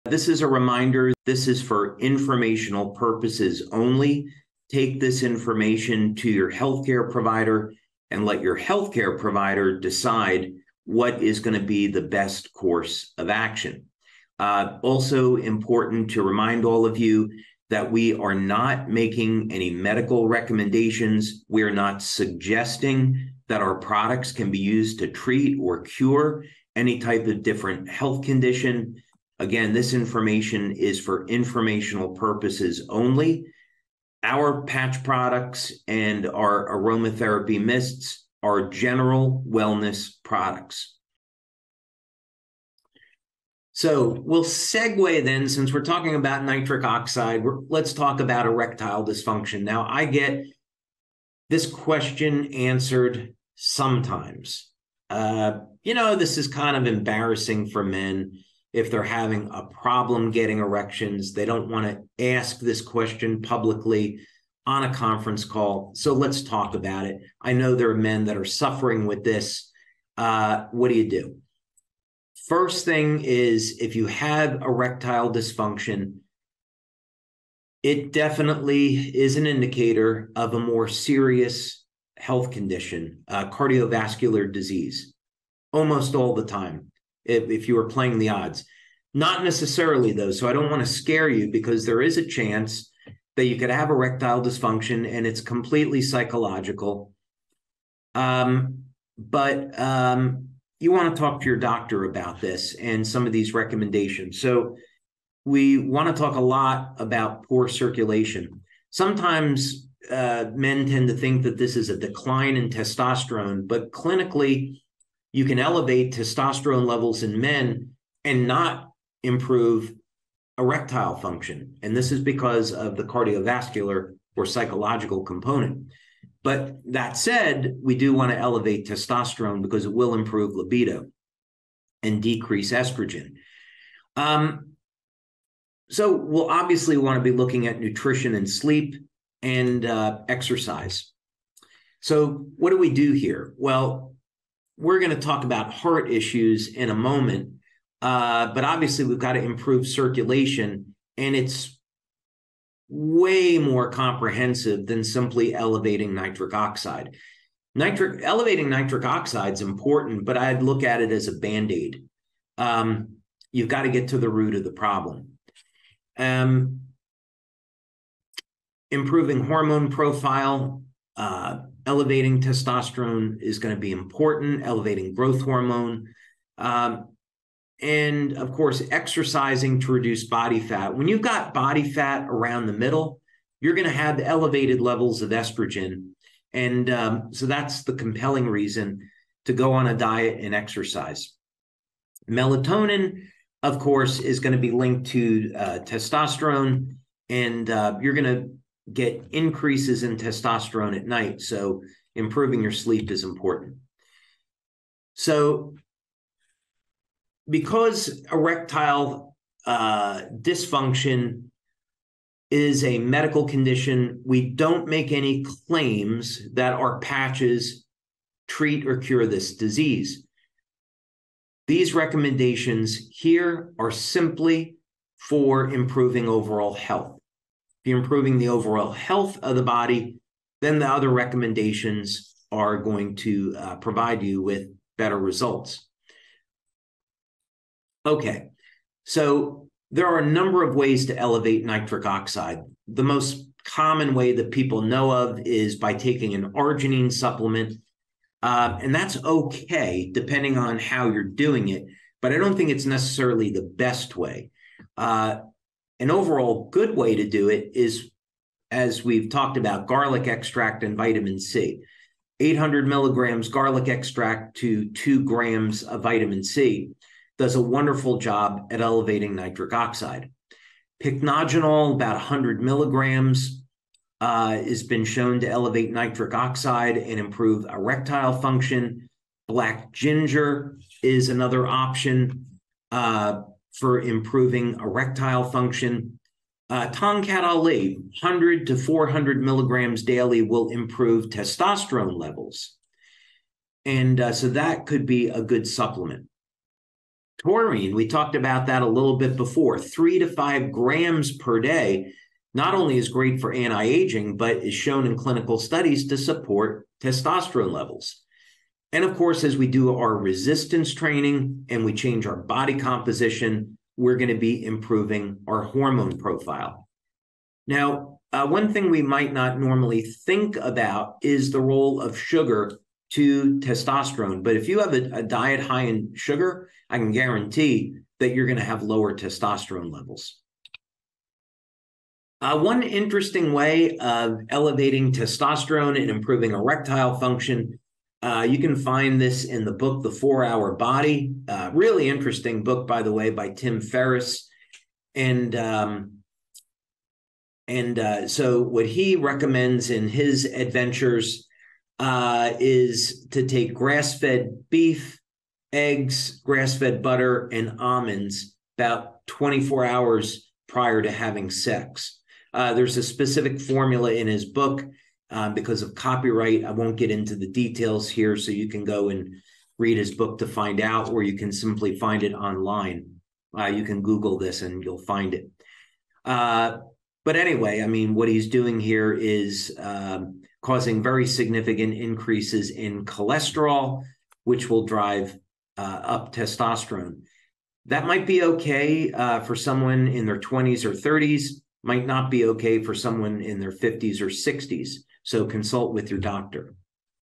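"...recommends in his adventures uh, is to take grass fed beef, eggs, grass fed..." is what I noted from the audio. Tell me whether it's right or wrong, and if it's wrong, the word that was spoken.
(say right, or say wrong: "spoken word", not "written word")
right.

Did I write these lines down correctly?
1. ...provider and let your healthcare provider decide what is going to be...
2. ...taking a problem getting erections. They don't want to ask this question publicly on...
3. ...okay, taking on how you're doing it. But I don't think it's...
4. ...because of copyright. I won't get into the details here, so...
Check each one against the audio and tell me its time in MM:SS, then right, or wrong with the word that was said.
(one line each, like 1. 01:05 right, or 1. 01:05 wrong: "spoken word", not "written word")
1. 00:07 right
2. 00:59 wrong: "having", not "taking"
3. 04:09 wrong: "depending", not "taking"
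4. 06:05 right.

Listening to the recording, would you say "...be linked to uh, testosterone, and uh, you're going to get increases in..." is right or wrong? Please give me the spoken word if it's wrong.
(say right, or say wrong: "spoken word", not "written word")
right.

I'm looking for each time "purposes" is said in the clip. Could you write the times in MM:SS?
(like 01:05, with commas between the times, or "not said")
00:02, 00:32.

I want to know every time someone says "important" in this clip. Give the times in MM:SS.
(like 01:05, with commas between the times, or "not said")
00:15, 02:39, 02:53, 03:23.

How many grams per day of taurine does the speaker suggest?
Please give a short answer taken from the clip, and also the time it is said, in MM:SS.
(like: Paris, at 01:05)
3 to 5 grams, at 04:59.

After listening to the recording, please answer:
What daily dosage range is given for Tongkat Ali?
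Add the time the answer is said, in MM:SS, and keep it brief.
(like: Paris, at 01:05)
100 to 400 milligrams, at 04:48.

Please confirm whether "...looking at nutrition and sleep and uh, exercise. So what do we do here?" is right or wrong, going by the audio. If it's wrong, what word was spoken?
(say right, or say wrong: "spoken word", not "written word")
right.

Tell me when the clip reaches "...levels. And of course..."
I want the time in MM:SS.
05:07.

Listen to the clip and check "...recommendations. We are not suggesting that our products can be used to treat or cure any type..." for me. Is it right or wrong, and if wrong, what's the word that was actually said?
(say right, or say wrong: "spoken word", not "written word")
right.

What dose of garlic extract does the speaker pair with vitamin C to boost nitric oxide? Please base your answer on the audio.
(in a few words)
800 milligrams.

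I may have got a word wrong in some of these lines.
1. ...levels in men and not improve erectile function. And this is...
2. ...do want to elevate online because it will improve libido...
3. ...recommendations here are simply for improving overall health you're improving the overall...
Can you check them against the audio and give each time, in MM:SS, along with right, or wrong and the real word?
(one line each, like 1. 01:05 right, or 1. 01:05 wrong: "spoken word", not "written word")
1. 01:56 right
2. 02:07 wrong: "testosterone", not "online"
3. 03:41 right.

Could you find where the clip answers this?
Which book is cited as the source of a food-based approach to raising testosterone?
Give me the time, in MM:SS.
05:40.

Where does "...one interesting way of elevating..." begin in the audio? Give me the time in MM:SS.
05:32.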